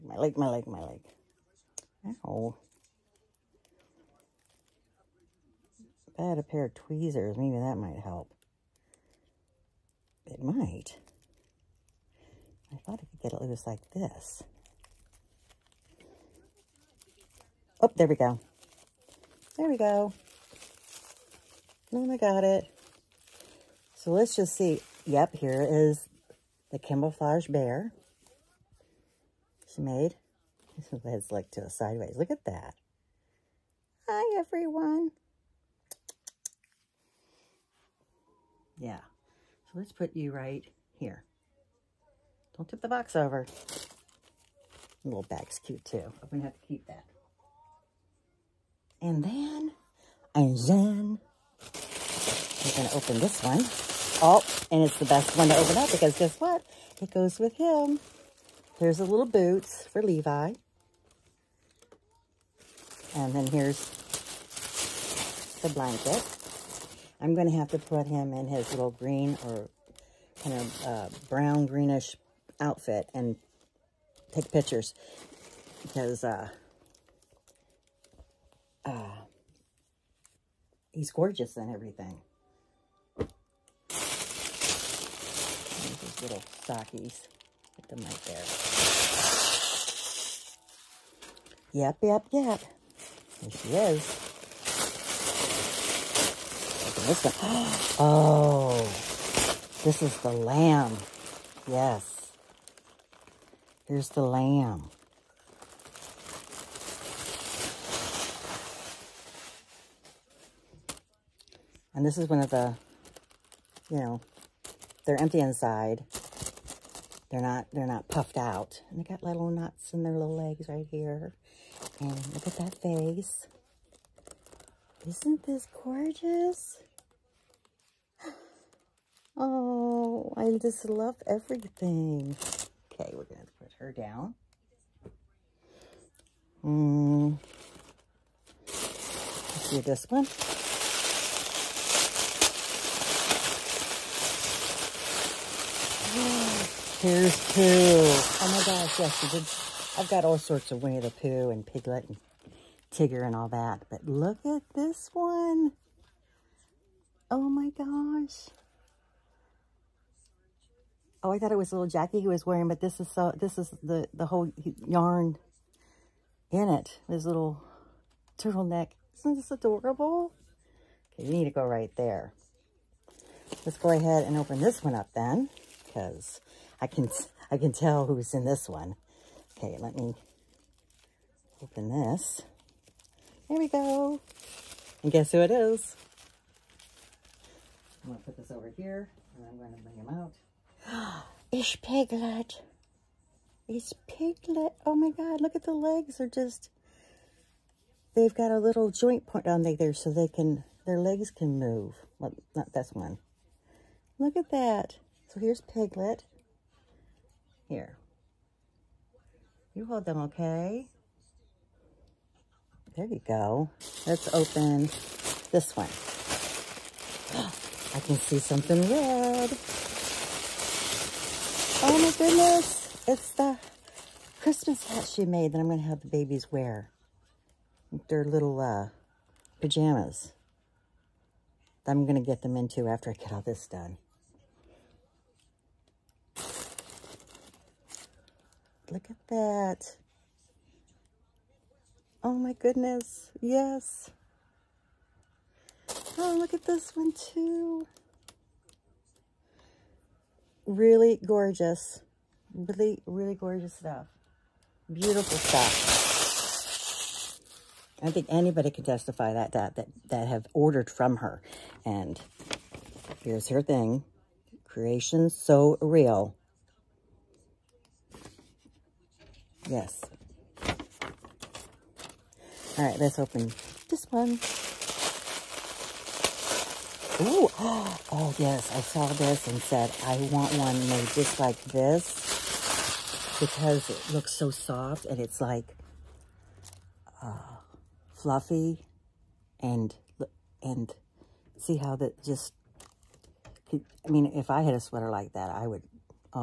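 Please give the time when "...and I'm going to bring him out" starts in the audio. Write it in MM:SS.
03:09.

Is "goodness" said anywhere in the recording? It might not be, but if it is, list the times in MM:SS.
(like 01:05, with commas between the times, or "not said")
03:42, 04:02.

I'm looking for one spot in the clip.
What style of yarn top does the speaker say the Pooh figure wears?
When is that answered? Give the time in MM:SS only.
02:48.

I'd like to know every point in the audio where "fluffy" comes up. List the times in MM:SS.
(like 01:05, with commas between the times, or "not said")
04:48.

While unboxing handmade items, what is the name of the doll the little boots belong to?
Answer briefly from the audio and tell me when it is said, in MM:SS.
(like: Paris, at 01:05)
Levi, at 00:59.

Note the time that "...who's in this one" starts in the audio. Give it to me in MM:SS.
02:58.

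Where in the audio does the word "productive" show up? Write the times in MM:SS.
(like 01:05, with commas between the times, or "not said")
not said.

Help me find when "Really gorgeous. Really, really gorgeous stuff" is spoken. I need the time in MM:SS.
04:10.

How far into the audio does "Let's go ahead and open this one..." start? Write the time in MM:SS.
02:53.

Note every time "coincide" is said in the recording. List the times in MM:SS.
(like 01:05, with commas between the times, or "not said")
not said.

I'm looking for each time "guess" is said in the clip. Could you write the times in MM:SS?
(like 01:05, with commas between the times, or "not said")
00:56, 03:05.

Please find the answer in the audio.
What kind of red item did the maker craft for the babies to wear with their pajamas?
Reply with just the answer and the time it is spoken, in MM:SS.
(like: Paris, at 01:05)
Christmas hat, at 03:44.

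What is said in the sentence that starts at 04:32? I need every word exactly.
All right, let's open this one.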